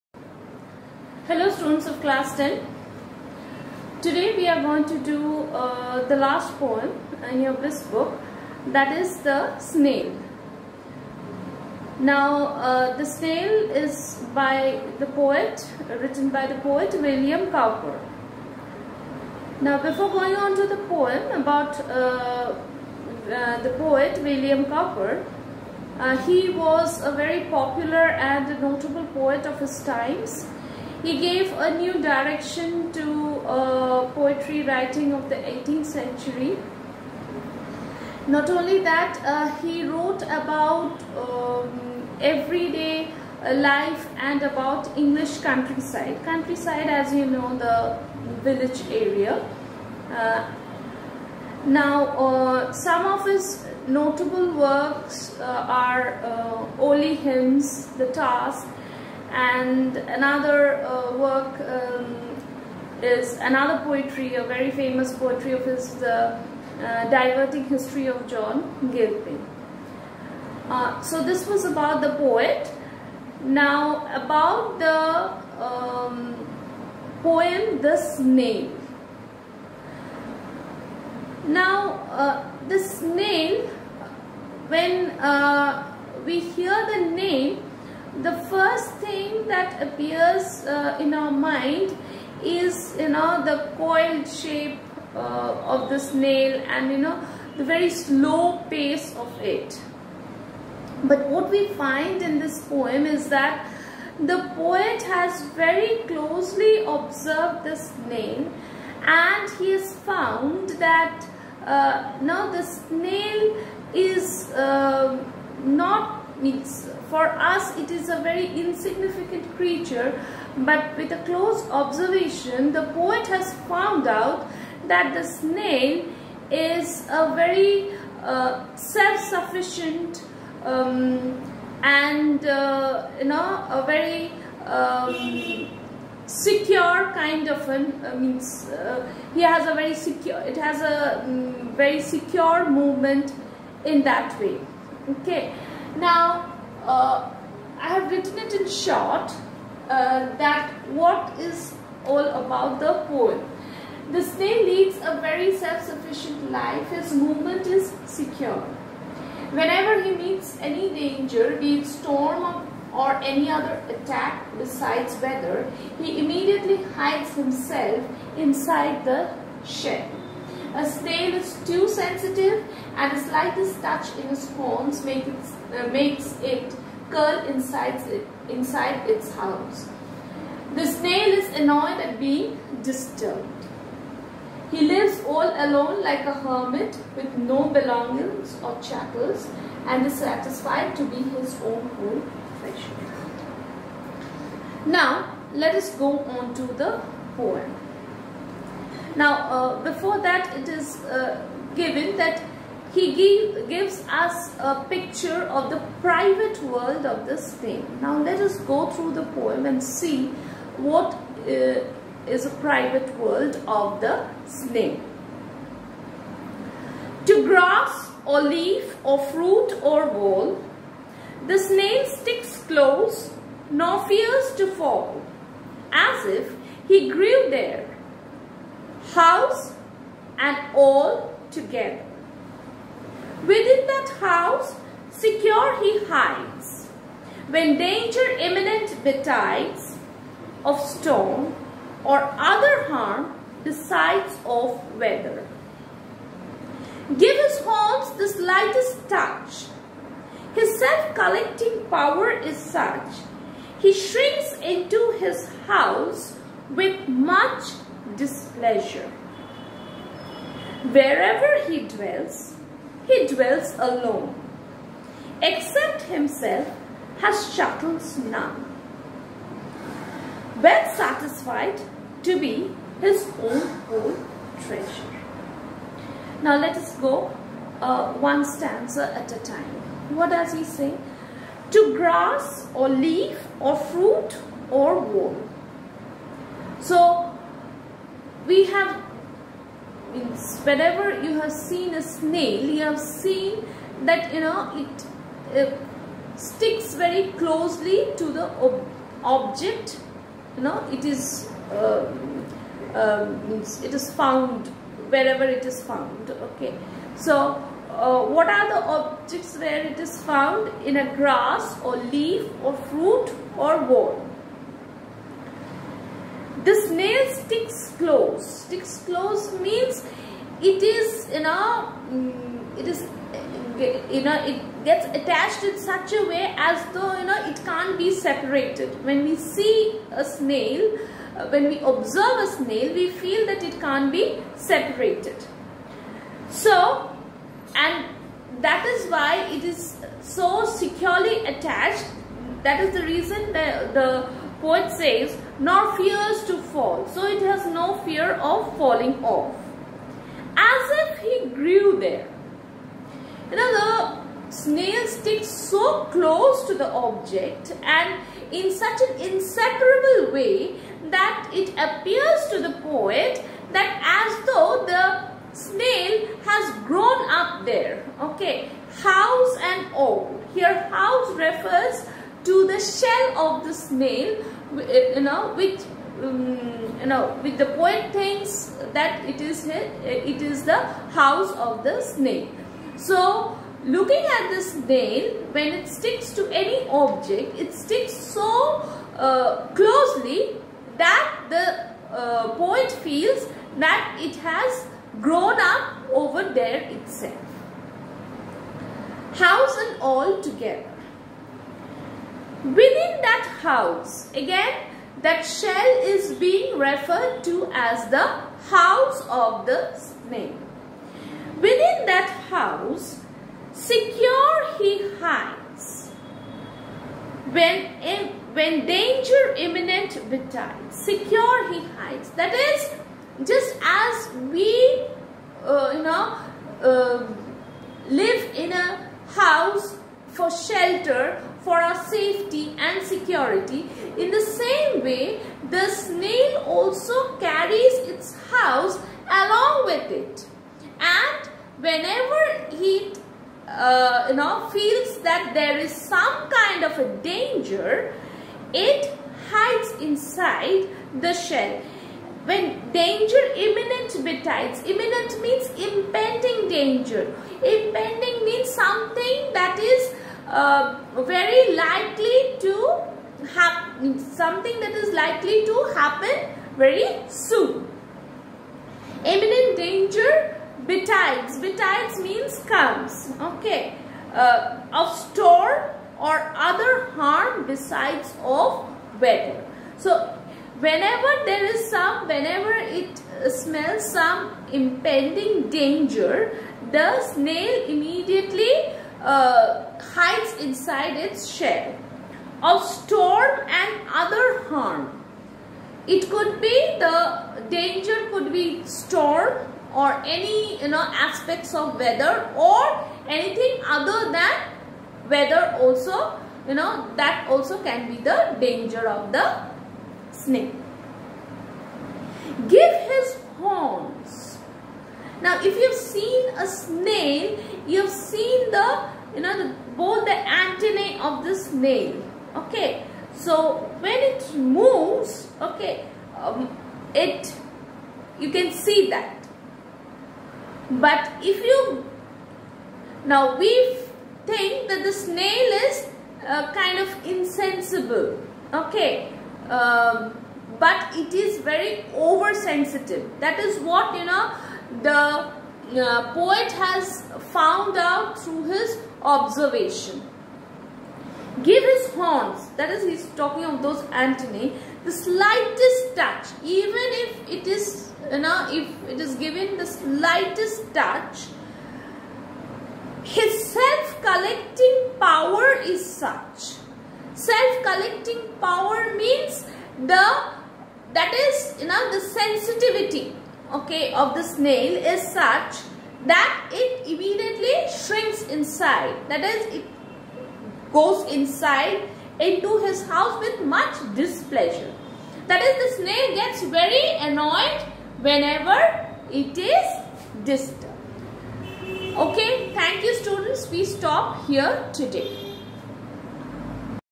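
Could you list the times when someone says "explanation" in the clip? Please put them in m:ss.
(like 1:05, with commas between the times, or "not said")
not said.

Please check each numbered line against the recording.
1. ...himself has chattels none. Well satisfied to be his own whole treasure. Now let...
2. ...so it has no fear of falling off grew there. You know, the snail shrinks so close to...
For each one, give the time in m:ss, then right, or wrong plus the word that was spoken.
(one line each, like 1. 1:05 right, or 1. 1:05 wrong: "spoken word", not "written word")
1. 4:26 right
2. 5:47 wrong: "sticks", not "shrinks".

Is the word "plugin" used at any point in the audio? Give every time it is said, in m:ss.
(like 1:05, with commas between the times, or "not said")
not said.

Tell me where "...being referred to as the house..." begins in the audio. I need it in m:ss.
6:46.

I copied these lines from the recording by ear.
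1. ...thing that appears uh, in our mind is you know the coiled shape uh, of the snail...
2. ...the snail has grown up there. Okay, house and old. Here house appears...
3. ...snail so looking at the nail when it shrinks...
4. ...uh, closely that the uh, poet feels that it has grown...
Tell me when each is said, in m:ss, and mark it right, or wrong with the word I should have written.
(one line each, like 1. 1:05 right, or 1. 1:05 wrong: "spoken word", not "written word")
1. 1:28 right
2. 6:04 wrong: "refers", not "appears"
3. 6:22 wrong: "sticks", not "shrinks"
4. 6:29 right.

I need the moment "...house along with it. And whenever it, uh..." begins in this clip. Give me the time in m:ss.
7:18.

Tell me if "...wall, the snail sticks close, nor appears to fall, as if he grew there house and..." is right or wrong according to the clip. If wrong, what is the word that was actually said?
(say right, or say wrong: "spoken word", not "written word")
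wrong: "fears", not "appears".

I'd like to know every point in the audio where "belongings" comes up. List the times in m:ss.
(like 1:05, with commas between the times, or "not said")
3:07.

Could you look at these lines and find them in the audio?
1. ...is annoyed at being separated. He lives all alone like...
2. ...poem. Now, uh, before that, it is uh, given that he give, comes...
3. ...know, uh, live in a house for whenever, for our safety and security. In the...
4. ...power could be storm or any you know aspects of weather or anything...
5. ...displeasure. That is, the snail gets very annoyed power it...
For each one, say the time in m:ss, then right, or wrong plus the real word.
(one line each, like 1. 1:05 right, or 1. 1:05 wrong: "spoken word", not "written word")
1. 3:01 wrong: "disturbed", not "separated"
2. 3:17 wrong: "gives", not "comes"
3. 7:06 wrong: "shelter", not "whenever"
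4. 8:17 wrong: "danger", not "power"
5. 9:44 wrong: "whenever", not "power".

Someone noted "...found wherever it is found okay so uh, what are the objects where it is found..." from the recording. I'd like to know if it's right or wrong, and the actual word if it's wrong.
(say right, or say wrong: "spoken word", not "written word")
right.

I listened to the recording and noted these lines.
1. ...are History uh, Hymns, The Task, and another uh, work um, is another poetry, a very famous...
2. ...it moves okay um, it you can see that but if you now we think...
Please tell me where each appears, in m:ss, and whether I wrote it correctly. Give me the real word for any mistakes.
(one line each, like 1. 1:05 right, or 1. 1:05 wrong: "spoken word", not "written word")
1. 0:55 wrong: "Olney", not "History"
2. 8:44 right.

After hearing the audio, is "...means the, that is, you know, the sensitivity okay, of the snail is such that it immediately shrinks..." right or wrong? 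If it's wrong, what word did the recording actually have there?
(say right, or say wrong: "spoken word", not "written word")
right.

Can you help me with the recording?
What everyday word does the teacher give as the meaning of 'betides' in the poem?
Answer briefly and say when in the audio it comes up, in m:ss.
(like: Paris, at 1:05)
comes, at 7:52.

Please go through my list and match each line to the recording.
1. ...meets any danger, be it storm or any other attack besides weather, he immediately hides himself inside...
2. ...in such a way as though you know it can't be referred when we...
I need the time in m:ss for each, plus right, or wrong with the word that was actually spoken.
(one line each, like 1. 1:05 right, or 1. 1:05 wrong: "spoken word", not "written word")
1. 2:40 right
2. 5:25 wrong: "separated", not "referred".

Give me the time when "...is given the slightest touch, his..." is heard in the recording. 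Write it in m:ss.
9:19.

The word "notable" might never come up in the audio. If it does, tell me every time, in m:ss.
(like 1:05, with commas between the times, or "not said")
0:28, 0:53.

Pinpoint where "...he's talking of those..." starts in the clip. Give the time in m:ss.
9:13.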